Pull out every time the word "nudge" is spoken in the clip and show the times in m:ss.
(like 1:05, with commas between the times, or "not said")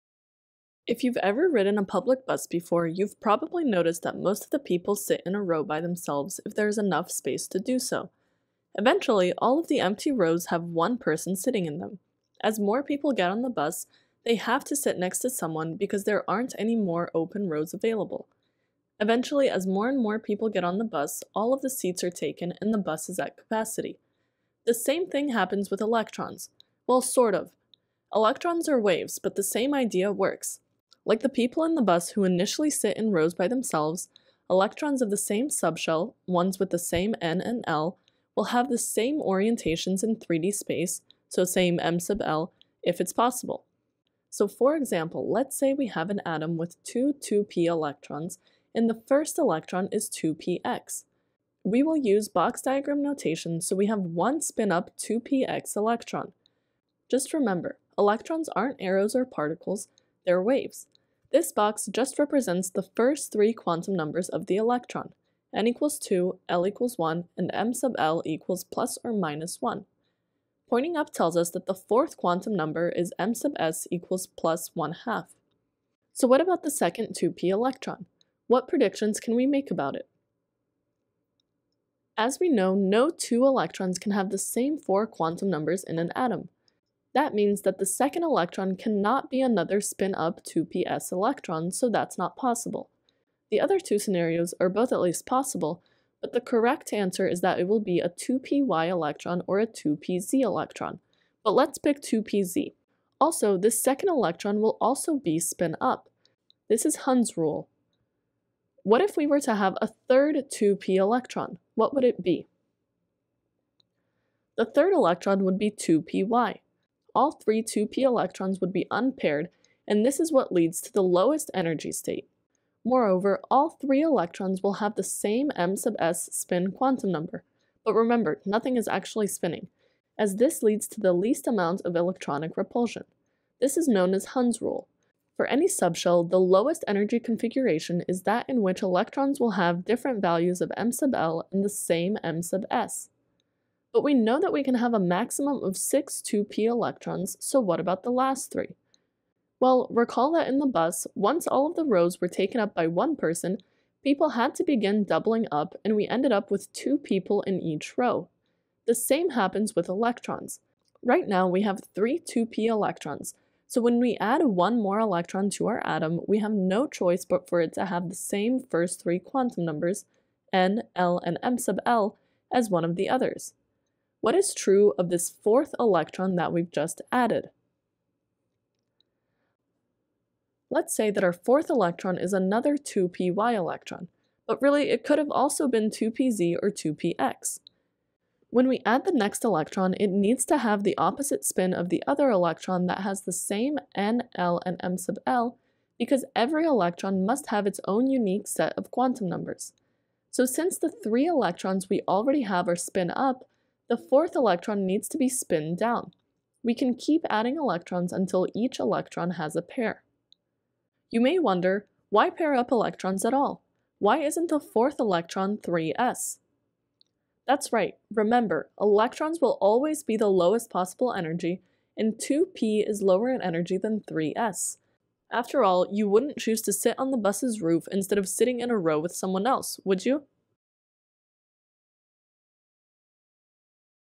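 not said.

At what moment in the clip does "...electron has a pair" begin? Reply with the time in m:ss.
3:28.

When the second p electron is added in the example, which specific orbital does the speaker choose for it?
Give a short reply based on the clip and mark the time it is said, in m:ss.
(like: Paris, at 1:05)
2pz, at 1:41.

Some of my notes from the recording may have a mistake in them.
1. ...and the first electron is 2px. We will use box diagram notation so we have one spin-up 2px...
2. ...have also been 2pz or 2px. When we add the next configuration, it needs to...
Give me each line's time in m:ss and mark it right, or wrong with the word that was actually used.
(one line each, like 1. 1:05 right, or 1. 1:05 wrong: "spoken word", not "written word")
1. 0:48 right
2. 3:05 wrong: "electron", not "configuration".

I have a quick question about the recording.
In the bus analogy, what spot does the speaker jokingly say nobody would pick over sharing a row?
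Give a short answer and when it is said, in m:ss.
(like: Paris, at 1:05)
The bus's roof, at 3:47.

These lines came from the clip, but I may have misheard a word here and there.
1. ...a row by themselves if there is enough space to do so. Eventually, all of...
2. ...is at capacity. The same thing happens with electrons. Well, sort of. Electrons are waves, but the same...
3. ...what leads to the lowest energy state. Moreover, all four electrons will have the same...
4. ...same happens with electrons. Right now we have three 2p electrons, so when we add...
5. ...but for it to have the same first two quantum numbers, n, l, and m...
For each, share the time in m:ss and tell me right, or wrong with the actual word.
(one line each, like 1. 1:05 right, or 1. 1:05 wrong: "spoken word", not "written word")
1. 0:05 right
2. 0:23 right
3. 2:00 wrong: "three", not "four"
4. 2:38 right
5. 2:47 wrong: "three", not "two".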